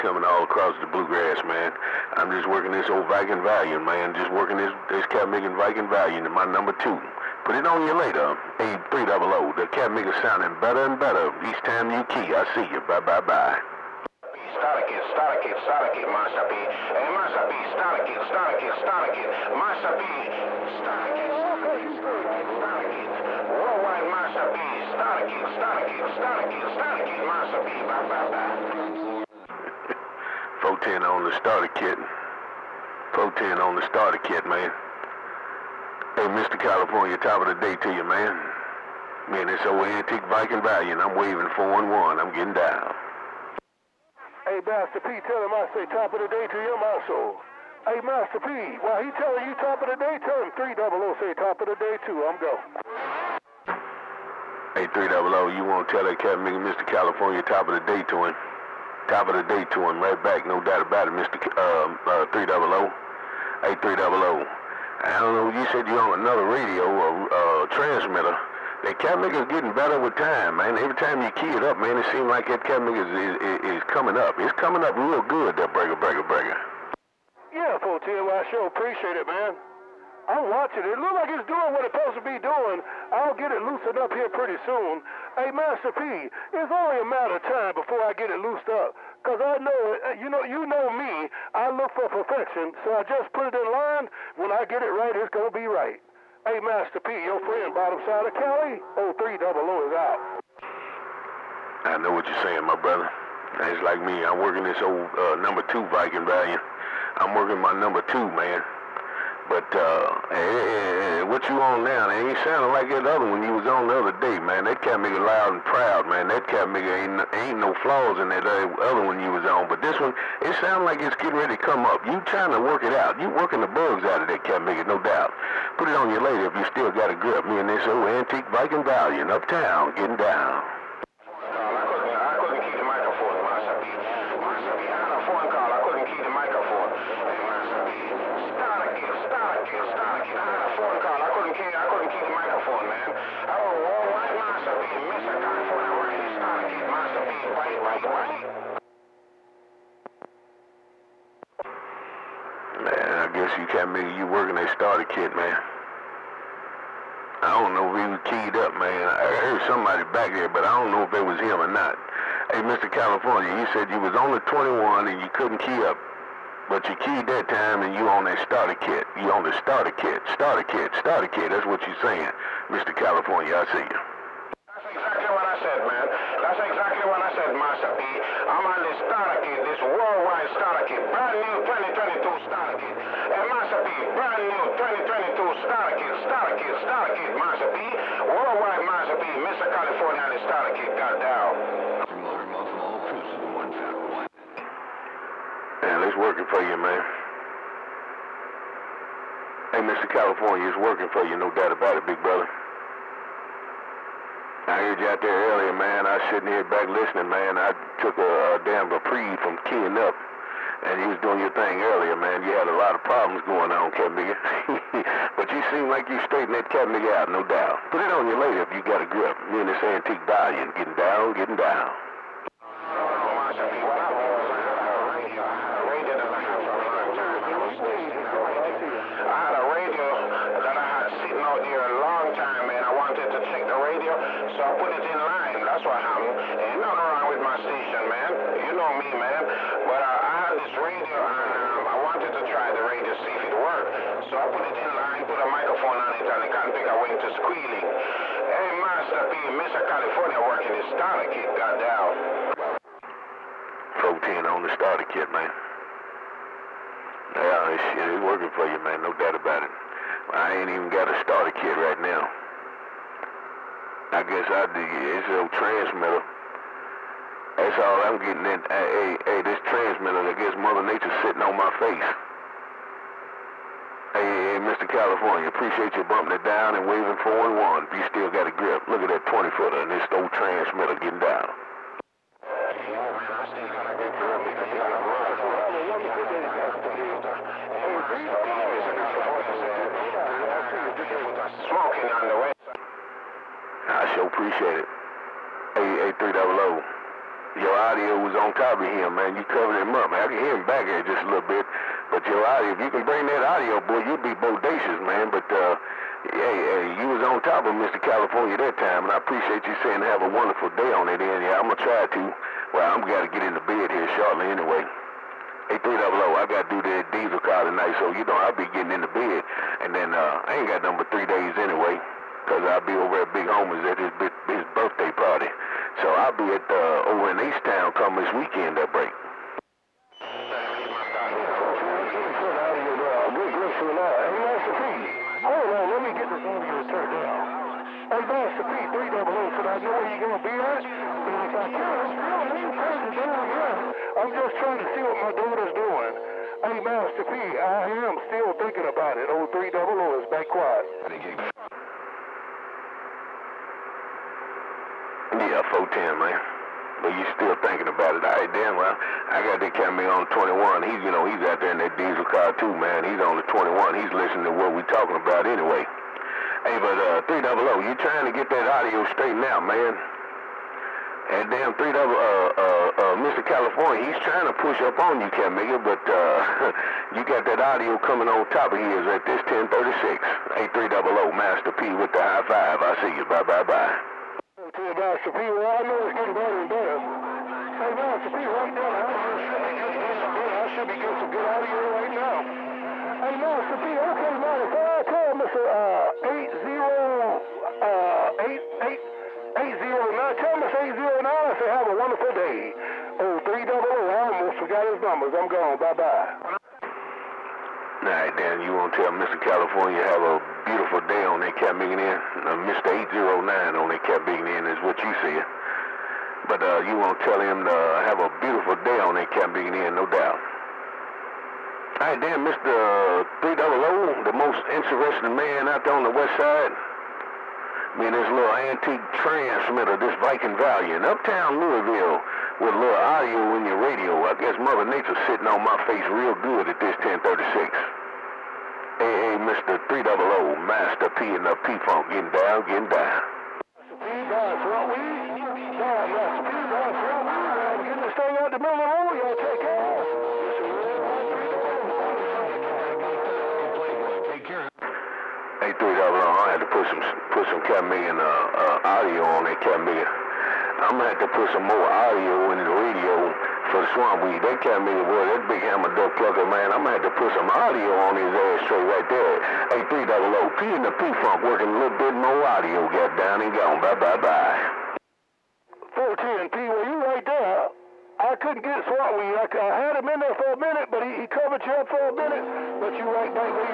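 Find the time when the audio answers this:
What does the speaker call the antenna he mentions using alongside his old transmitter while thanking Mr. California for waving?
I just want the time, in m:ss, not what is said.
4:39.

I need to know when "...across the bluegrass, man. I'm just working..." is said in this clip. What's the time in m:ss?
0:00.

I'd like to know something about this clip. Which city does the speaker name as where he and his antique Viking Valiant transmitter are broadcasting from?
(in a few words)
Louisville.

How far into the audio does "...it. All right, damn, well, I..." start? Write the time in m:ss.
5:58.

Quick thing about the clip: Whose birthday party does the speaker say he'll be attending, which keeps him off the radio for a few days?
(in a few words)
Big Homer's.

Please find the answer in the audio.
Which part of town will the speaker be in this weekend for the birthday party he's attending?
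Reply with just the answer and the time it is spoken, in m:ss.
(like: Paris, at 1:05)
East Town, at 5:27.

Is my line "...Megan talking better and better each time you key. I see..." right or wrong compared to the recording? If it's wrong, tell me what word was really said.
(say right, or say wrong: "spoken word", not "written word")
wrong: "sounding", not "talking".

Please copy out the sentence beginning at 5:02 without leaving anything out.
But your audio, if you can bring that audio, boy, you'd be bodacious, man.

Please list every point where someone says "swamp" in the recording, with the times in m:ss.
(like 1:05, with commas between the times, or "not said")
7:43, 7:58.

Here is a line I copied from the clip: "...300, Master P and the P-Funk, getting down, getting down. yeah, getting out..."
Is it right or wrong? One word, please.
right.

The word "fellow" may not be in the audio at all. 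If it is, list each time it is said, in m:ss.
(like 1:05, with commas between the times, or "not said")
not said.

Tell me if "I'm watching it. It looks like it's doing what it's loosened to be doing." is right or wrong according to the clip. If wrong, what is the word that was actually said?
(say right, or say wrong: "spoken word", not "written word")
wrong: "supposed", not "loosened".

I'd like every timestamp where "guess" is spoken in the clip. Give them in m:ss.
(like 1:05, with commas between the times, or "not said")
4:24, 4:30, 7:14.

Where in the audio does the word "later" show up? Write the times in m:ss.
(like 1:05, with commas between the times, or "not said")
0:07, 2:06, 3:38.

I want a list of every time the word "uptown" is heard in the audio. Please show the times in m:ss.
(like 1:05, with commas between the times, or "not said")
2:09, 7:11.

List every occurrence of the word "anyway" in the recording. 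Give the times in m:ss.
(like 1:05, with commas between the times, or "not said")
5:14, 5:21, 6:05.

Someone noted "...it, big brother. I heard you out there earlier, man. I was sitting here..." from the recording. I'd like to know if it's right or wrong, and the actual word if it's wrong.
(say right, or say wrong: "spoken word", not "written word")
right.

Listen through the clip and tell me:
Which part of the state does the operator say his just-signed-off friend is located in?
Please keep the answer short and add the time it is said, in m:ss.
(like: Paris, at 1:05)
bottom side of Cali, at 1:37.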